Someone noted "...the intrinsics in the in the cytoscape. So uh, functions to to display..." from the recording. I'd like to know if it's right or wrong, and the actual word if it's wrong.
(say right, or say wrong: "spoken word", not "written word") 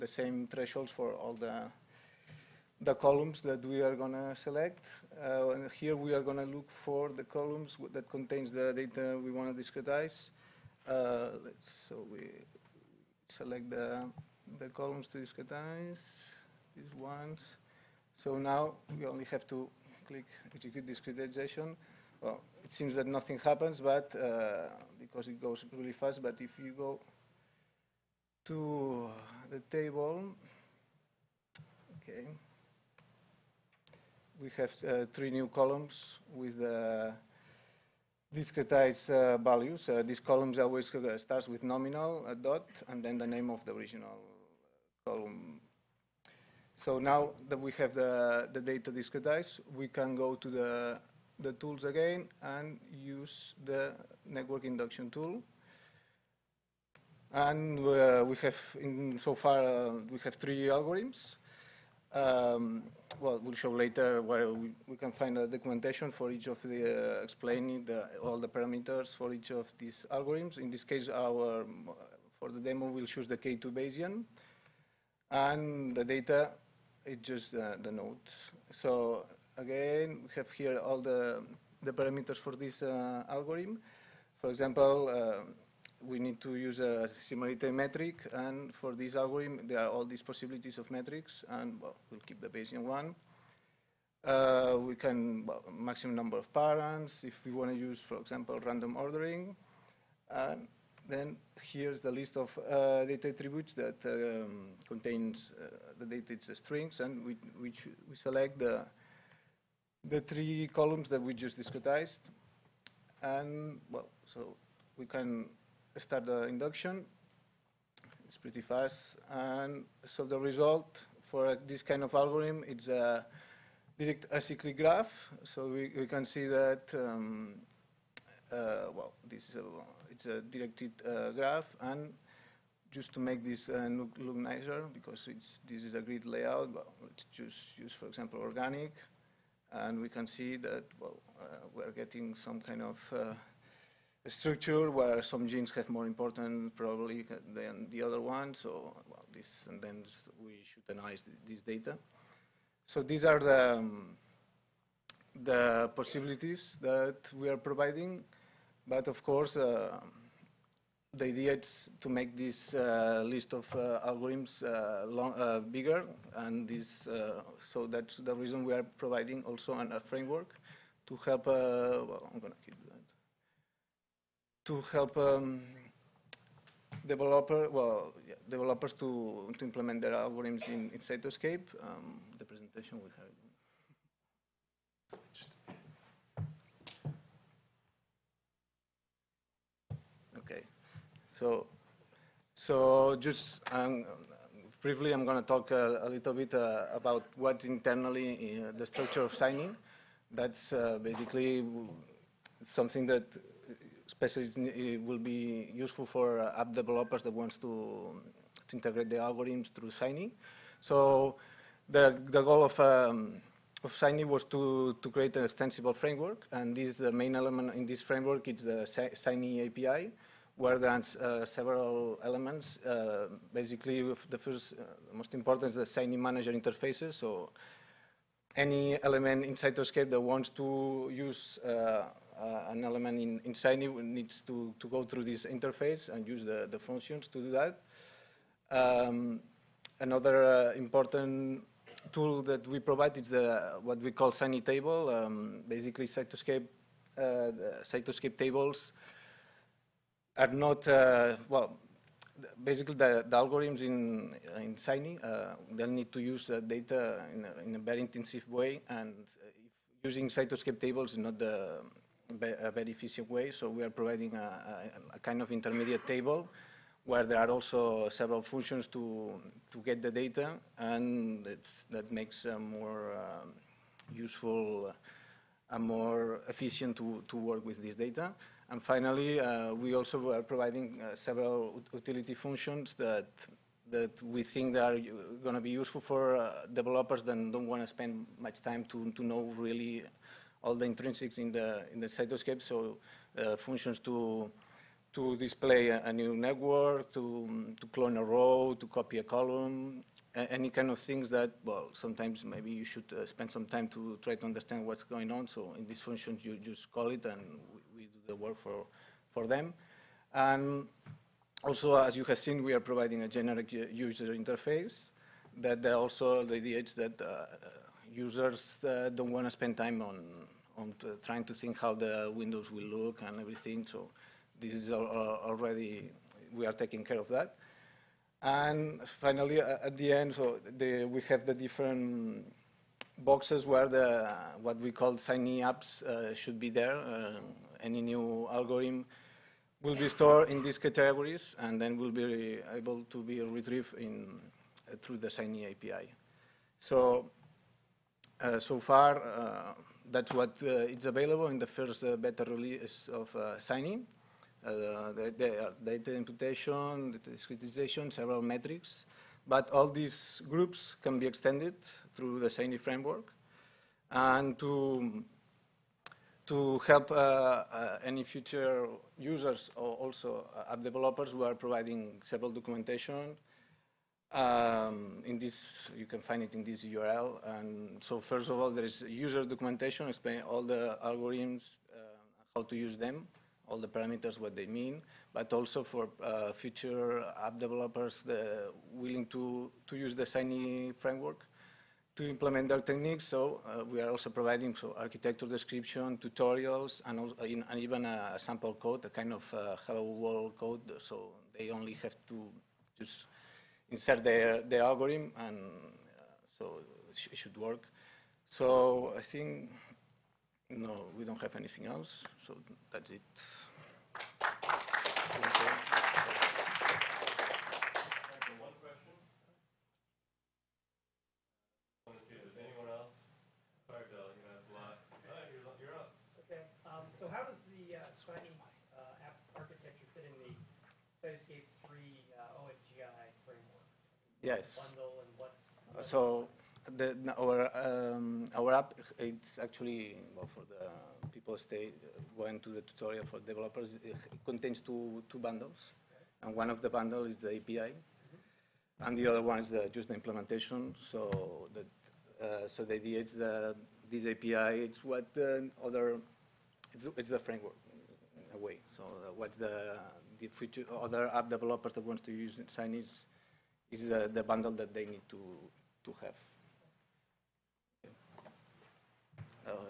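right.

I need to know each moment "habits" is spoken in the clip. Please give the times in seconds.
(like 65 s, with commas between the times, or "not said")
not said.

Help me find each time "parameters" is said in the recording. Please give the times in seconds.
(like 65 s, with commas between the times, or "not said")
68 s, 81 s, 383 s.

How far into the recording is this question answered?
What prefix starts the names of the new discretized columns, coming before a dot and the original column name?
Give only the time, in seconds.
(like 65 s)
41 s.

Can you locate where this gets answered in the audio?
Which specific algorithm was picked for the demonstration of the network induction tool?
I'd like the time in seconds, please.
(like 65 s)
73 s.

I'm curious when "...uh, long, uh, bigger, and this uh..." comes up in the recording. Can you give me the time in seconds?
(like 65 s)
164 s.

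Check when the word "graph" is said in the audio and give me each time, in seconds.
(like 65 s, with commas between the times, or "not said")
124 s, 131 s.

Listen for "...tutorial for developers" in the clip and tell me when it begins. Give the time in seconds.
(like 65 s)
442 s.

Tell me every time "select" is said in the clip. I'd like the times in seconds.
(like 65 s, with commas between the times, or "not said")
4 s, 13 s, 108 s.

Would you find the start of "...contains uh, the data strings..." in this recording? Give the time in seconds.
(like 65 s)
104 s.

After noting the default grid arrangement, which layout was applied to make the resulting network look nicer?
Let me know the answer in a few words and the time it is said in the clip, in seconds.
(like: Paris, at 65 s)
Organic, at 138 s.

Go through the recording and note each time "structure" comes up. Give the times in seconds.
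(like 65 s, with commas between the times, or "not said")
144 s, 198 s.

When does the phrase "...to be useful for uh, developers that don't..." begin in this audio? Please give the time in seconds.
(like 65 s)
285 s.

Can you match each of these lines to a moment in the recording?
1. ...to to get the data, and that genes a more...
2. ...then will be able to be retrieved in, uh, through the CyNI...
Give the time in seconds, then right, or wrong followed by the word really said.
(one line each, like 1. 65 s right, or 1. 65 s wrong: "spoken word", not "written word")
1. 268 s wrong: "makes", not "genes"
2. 341 s right.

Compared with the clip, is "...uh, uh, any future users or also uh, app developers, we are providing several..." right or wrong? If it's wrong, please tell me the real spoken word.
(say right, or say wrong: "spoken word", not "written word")
right.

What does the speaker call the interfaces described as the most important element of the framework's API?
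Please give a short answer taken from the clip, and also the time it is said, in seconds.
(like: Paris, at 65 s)
CyNI manager interfaces, at 225 s.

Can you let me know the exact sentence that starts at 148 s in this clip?
So well, this, and then we should analyze this data.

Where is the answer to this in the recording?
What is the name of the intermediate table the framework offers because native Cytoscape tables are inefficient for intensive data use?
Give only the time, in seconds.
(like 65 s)
244 s.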